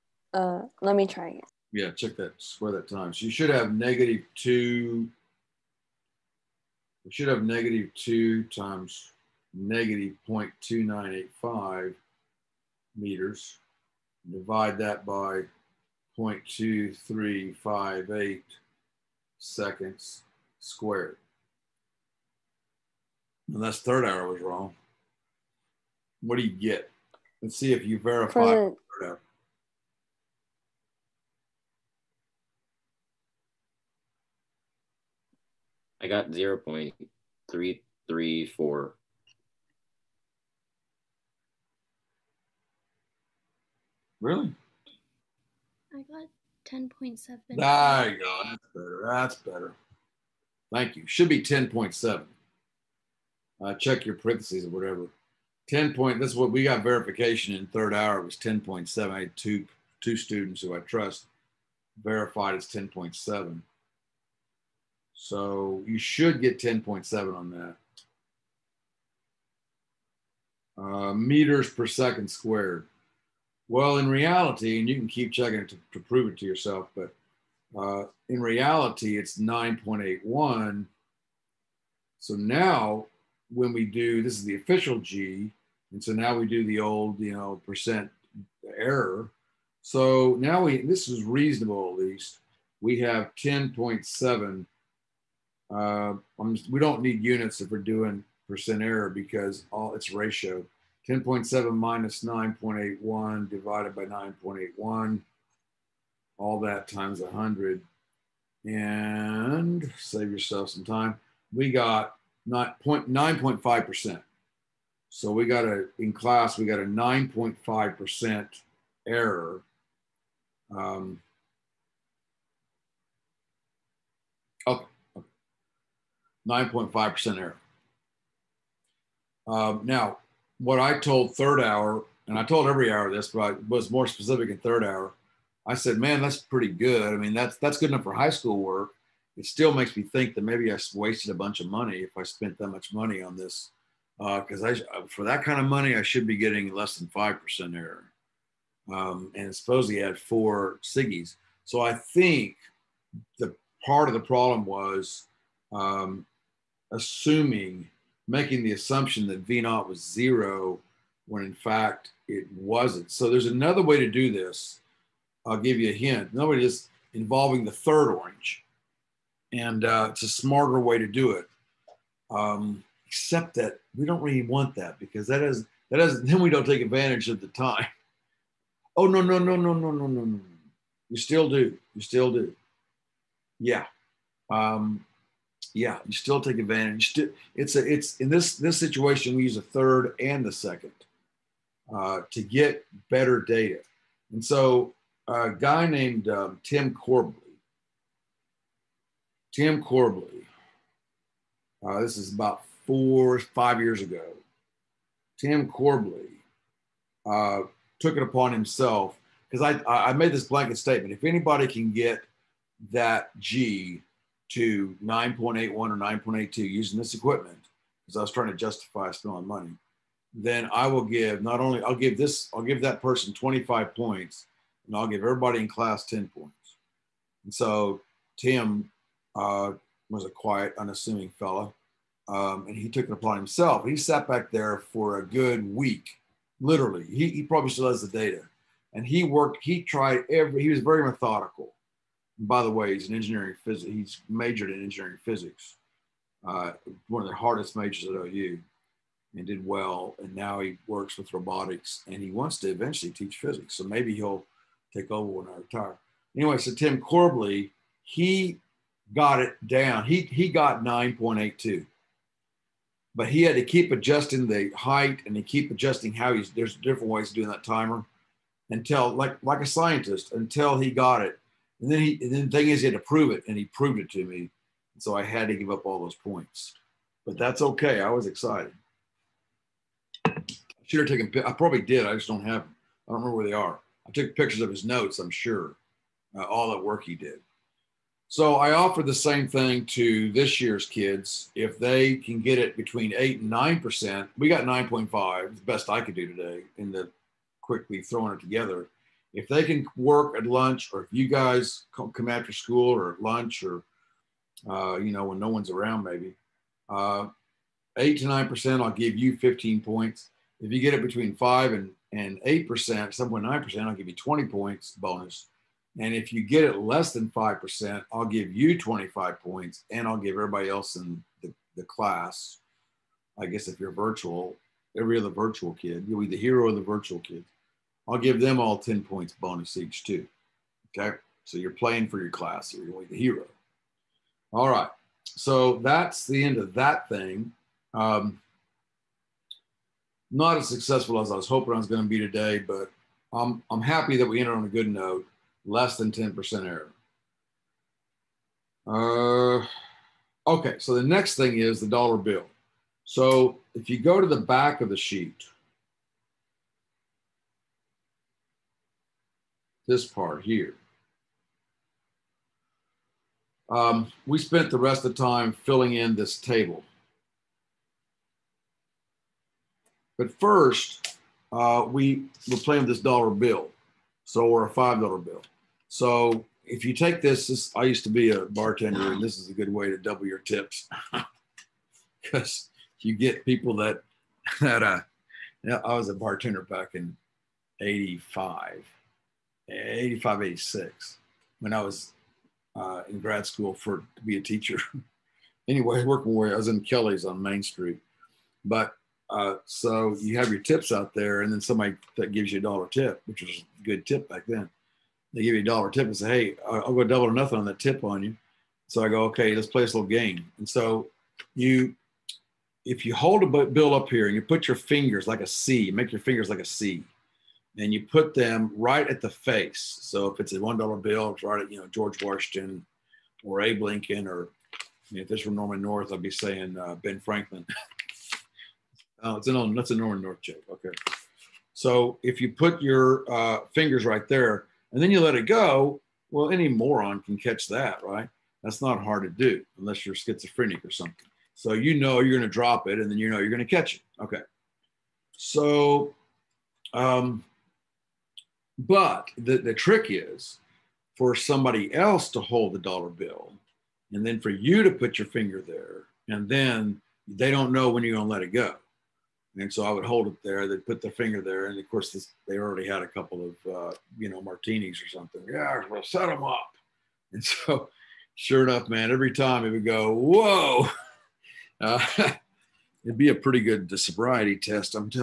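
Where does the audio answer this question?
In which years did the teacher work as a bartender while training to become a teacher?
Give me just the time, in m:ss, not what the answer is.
6:27.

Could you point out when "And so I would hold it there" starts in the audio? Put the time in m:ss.
7:39.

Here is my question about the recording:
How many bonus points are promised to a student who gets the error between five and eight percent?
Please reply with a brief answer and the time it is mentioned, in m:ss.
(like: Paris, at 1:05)
20 points, at 5:14.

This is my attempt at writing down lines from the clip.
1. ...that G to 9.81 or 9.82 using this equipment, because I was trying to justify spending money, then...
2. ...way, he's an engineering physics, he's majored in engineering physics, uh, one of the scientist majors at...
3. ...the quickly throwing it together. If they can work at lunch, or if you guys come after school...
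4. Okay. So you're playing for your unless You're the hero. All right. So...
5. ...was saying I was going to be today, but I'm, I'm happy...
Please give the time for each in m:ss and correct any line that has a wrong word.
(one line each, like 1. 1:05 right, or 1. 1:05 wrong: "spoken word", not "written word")
1. 3:32 right
2. 4:02 wrong: "hardest", not "scientist"
3. 4:56 right
4. 5:30 wrong: "class", not "unless"
5. 5:41 wrong: "hoping", not "saying".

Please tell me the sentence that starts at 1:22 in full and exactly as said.
So now when we do, this is the official G, and so now we do the old, you know, percent error.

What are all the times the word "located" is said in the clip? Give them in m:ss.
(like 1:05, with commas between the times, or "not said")
not said.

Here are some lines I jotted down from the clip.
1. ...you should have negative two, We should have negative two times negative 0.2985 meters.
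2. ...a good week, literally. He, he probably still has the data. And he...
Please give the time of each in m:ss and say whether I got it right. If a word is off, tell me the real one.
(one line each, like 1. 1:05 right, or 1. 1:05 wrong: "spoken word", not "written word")
1. 0:03 right
2. 3:55 right.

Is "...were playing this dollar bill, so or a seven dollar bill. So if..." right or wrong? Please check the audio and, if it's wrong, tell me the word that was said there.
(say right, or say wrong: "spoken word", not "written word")
wrong: "five", not "seven".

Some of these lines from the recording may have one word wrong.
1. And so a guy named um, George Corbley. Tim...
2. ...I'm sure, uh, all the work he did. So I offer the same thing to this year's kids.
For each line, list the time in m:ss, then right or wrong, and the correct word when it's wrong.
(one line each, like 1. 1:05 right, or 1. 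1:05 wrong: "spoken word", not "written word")
1. 3:14 wrong: "Tim", not "George"
2. 4:45 right.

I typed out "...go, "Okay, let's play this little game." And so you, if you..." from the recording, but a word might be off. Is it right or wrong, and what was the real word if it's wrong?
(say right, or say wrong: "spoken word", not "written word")
right.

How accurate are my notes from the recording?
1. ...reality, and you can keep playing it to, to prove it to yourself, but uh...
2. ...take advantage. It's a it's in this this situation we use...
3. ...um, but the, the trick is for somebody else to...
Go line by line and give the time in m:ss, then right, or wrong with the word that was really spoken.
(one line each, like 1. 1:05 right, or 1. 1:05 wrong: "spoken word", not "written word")
1. 1:14 wrong: "checking", not "playing"
2. 3:06 right
3. 7:26 right.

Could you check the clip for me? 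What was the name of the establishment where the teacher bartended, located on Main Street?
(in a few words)
Kelly's.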